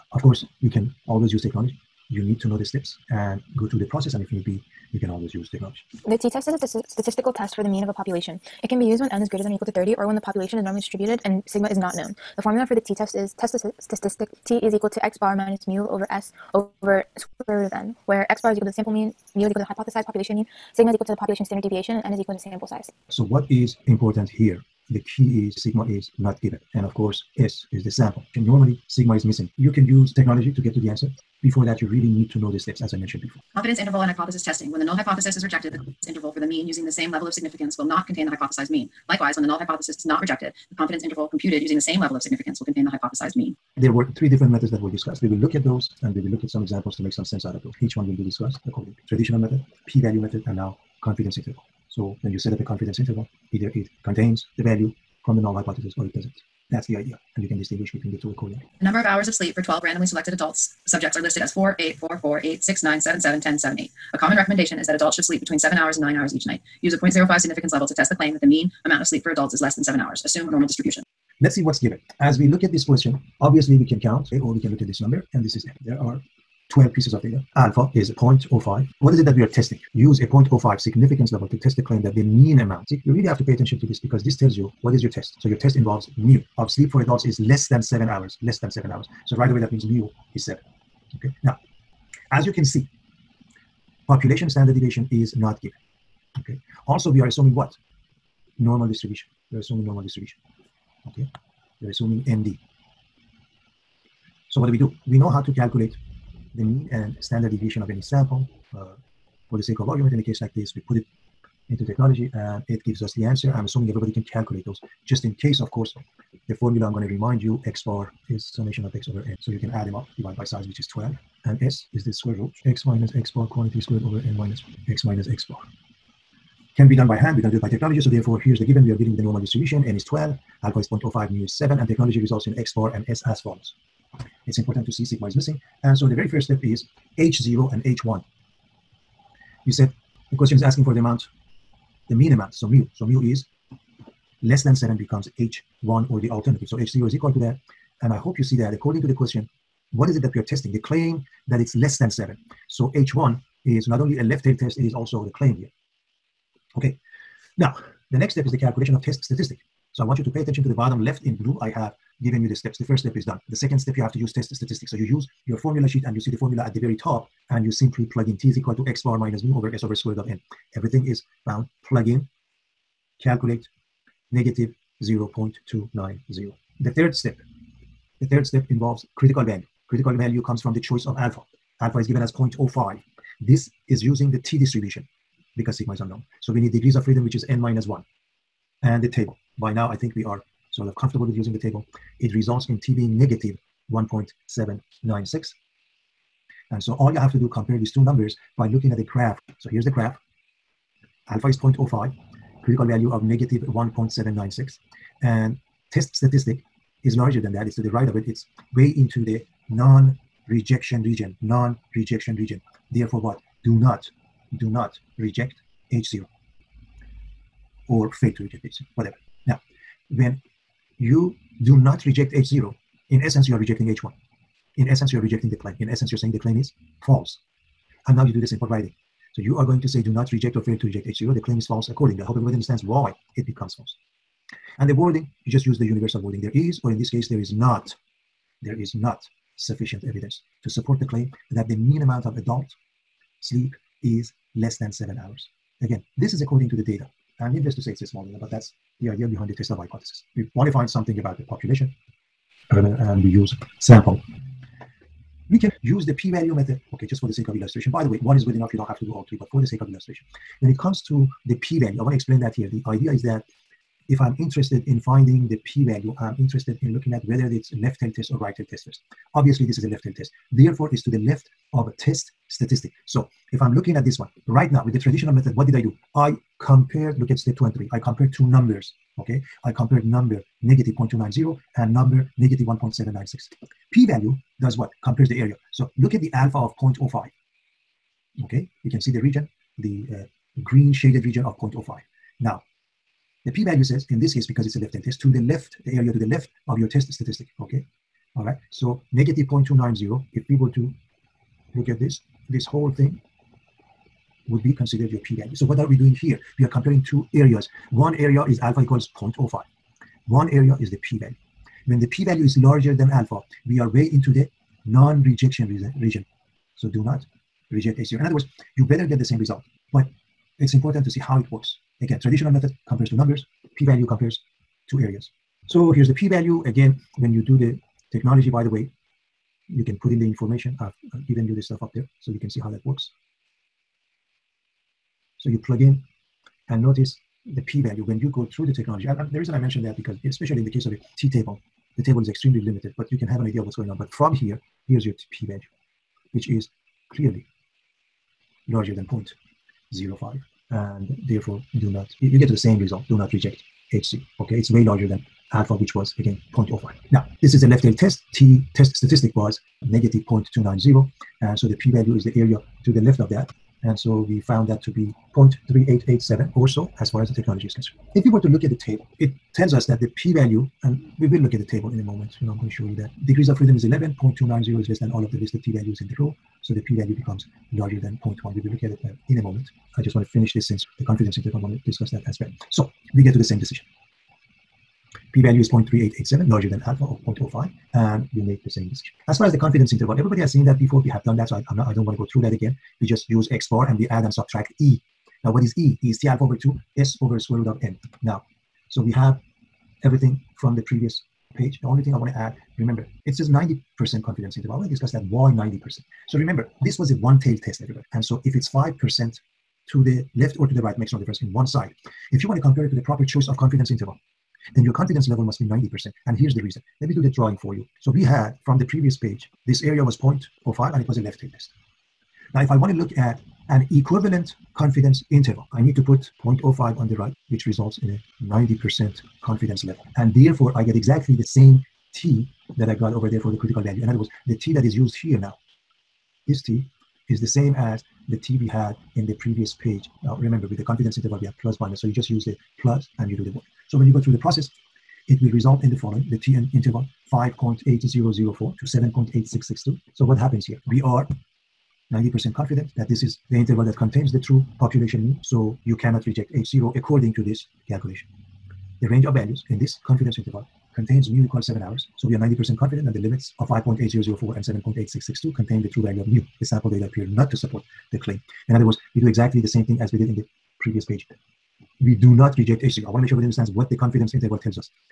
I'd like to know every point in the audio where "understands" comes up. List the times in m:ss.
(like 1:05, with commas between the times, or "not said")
3:52, 7:53.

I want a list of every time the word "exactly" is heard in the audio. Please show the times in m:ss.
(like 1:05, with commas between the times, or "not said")
7:10, 7:49.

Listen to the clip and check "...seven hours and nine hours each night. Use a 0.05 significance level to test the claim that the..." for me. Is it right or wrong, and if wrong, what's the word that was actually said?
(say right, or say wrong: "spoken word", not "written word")
right.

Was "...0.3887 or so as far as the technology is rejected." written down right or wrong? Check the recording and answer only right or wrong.
wrong.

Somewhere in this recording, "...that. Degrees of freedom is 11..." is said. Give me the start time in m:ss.
6:12.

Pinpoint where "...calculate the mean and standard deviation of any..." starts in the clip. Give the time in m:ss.
1:45.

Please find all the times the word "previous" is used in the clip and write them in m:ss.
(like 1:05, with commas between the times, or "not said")
6:40, 6:58, 7:19, 7:50.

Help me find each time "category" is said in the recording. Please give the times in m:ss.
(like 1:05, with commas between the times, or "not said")
not said.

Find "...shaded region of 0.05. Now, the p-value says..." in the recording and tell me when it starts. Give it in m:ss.
4:50.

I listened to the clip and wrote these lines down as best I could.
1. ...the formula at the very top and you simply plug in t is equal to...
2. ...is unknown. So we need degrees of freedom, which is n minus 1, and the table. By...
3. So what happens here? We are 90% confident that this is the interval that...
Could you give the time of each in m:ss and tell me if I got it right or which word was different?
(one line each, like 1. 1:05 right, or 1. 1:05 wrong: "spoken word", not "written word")
1. 2:46 right
2. 3:05 right
3. 7:30 right.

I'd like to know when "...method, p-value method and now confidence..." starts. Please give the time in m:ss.
0:49.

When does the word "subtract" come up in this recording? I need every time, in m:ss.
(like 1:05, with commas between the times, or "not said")
6:34.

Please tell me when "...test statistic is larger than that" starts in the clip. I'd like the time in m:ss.
3:25.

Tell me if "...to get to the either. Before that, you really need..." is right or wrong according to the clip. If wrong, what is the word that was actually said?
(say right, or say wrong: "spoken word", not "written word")
wrong: "answer", not "either".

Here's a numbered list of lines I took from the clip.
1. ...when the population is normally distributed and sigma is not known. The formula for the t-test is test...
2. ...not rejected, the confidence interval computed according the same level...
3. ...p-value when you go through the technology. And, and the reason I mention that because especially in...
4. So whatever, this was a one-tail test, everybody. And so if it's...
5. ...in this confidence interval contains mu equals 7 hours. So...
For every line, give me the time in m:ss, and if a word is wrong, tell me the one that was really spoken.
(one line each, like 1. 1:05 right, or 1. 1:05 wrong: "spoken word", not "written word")
1. 0:10 right
2. 0:40 wrong: "using", not "according"
3. 5:37 right
4. 6:46 wrong: "remember", not "whatever"
5. 7:39 right.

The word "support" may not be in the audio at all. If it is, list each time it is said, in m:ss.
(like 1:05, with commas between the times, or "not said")
4:00, 7:47.